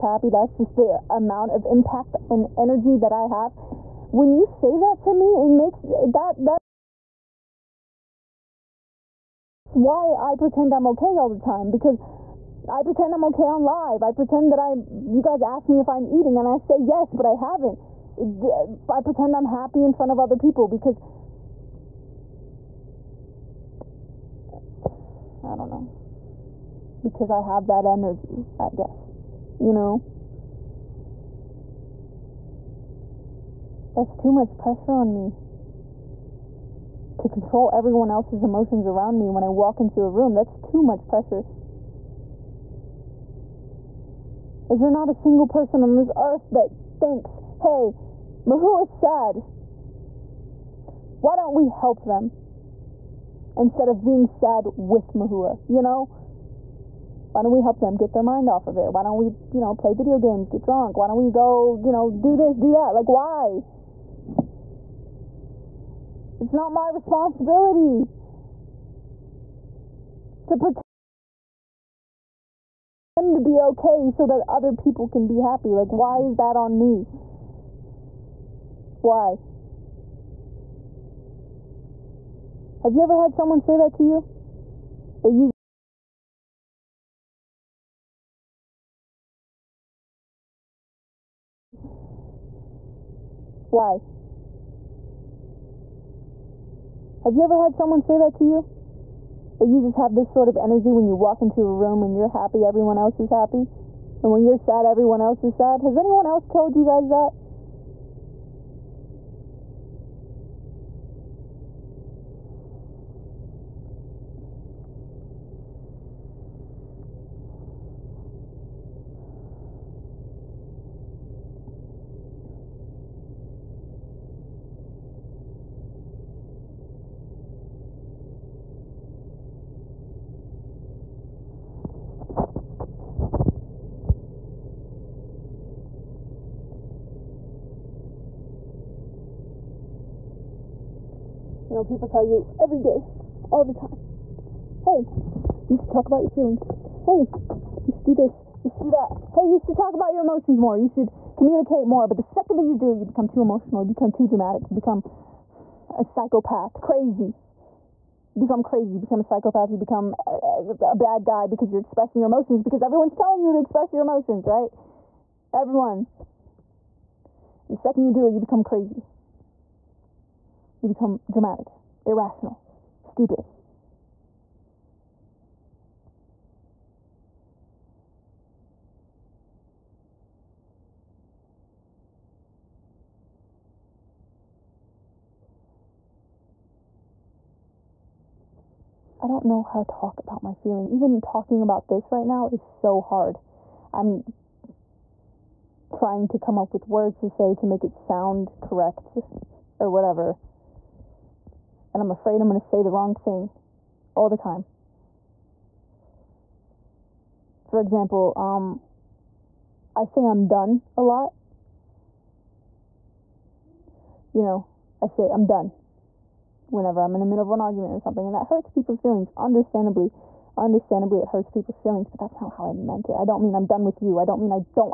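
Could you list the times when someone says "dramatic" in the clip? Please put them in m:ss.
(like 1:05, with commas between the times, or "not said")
2:34, 2:51.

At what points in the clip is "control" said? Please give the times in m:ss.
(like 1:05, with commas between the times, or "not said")
0:37.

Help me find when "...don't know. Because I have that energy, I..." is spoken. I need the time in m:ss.
0:25.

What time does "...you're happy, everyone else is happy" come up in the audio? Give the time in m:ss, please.
1:42.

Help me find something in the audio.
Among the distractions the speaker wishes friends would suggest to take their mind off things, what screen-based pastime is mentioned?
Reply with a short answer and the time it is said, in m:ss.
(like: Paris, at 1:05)
video games, at 0:59.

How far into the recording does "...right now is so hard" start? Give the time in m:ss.
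3:12.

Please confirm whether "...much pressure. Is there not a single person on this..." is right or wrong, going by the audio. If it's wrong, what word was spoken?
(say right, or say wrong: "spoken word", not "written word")
right.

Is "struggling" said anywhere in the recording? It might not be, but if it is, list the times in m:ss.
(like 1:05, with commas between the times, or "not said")
not said.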